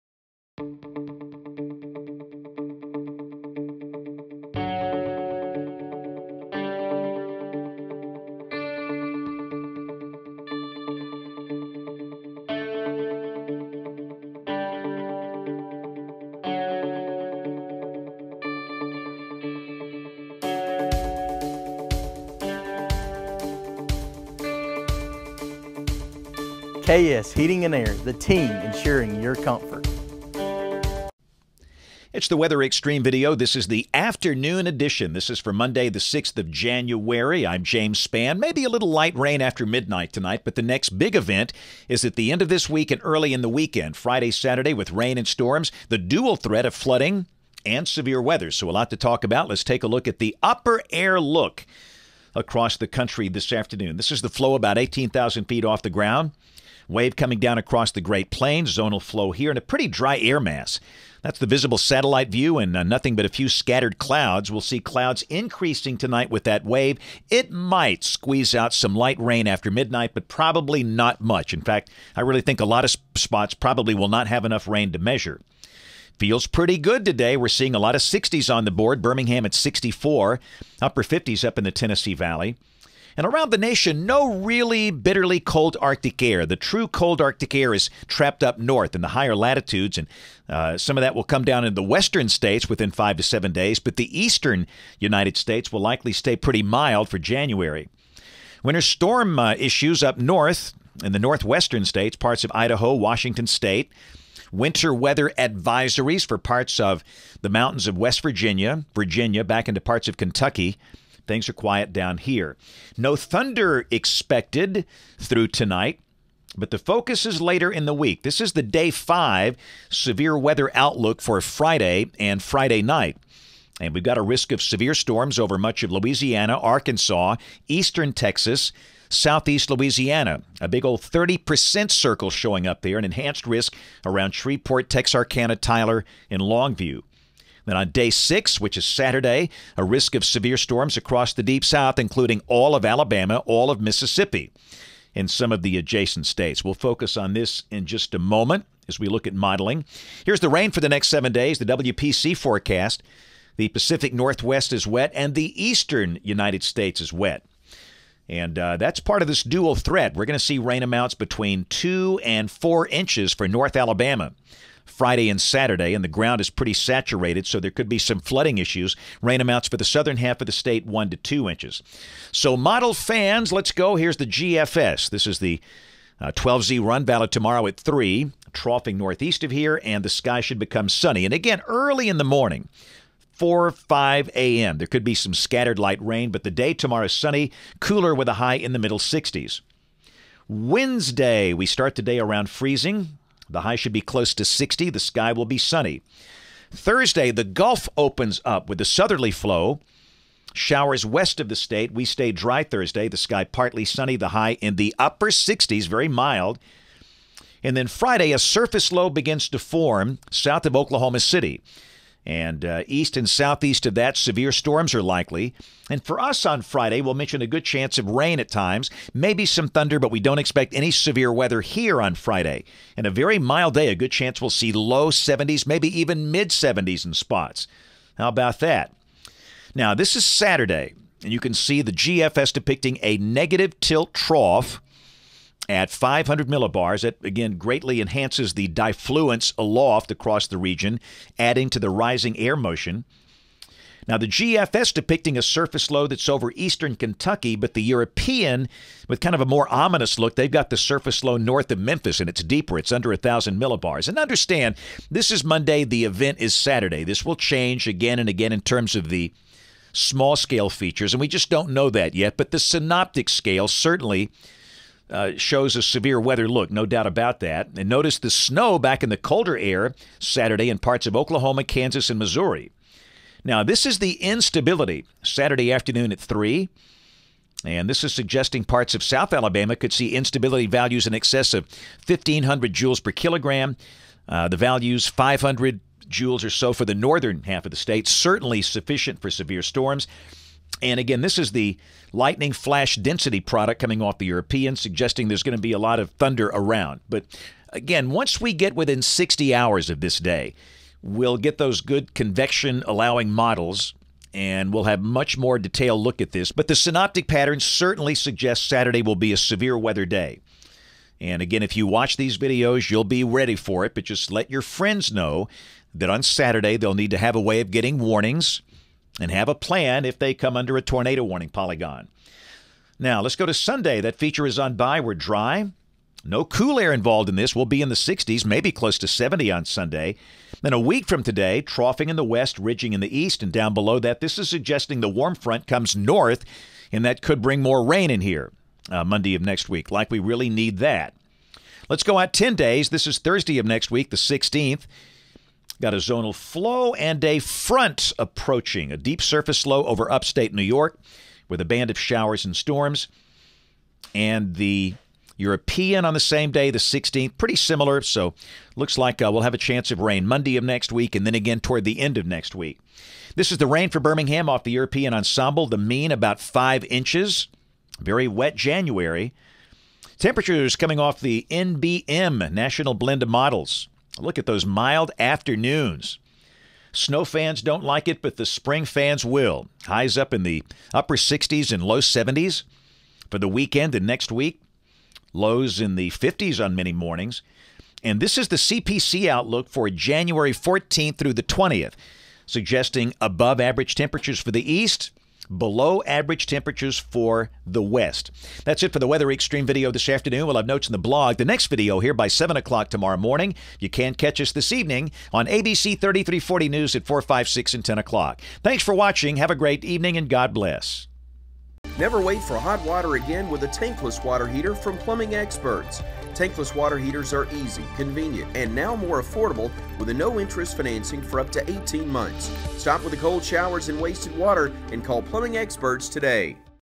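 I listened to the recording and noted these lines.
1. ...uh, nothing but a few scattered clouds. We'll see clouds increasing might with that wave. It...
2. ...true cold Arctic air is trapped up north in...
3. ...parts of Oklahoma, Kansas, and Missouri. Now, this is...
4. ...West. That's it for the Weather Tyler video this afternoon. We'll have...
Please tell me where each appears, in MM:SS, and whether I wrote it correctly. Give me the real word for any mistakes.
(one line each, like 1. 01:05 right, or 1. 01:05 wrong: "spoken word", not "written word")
1. 01:02 wrong: "tonight", not "might"
2. 01:26 right
3. 04:30 right
4. 06:37 wrong: "Xtreme", not "Tyler".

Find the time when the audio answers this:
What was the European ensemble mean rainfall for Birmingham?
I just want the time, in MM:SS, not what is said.
06:06.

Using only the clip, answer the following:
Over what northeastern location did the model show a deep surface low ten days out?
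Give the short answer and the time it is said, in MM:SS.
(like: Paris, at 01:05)
upstate New York, at 05:50.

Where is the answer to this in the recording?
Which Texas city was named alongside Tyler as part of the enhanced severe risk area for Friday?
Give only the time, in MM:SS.
02:16.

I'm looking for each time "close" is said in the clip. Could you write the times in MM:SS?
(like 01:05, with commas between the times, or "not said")
03:14, 05:28.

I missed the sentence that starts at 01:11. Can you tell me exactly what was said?
In fact, I really think a lot of spots probably will not have enough rain to measure.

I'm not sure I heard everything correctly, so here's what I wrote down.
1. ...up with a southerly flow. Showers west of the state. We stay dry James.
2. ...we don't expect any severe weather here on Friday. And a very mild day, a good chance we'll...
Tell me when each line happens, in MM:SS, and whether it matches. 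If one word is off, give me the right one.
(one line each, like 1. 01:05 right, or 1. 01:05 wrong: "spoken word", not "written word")
1. 03:18 wrong: "Thursday", not "James"
2. 03:40 right.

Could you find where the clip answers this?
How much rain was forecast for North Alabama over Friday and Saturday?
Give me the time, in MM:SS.
02:41.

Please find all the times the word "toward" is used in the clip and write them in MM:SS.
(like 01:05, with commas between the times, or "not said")
06:01.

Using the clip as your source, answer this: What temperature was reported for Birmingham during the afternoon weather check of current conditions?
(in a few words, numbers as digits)
64.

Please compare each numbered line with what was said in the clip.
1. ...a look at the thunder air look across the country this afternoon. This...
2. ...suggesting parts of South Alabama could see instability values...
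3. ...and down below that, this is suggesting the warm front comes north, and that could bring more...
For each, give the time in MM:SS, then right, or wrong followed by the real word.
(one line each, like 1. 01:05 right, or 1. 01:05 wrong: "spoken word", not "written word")
1. 00:49 wrong: "upper", not "thunder"
2. 04:38 right
3. 05:33 right.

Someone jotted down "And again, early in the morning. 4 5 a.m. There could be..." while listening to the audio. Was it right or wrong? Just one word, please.
right.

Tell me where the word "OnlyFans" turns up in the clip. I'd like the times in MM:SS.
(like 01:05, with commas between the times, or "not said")
not said.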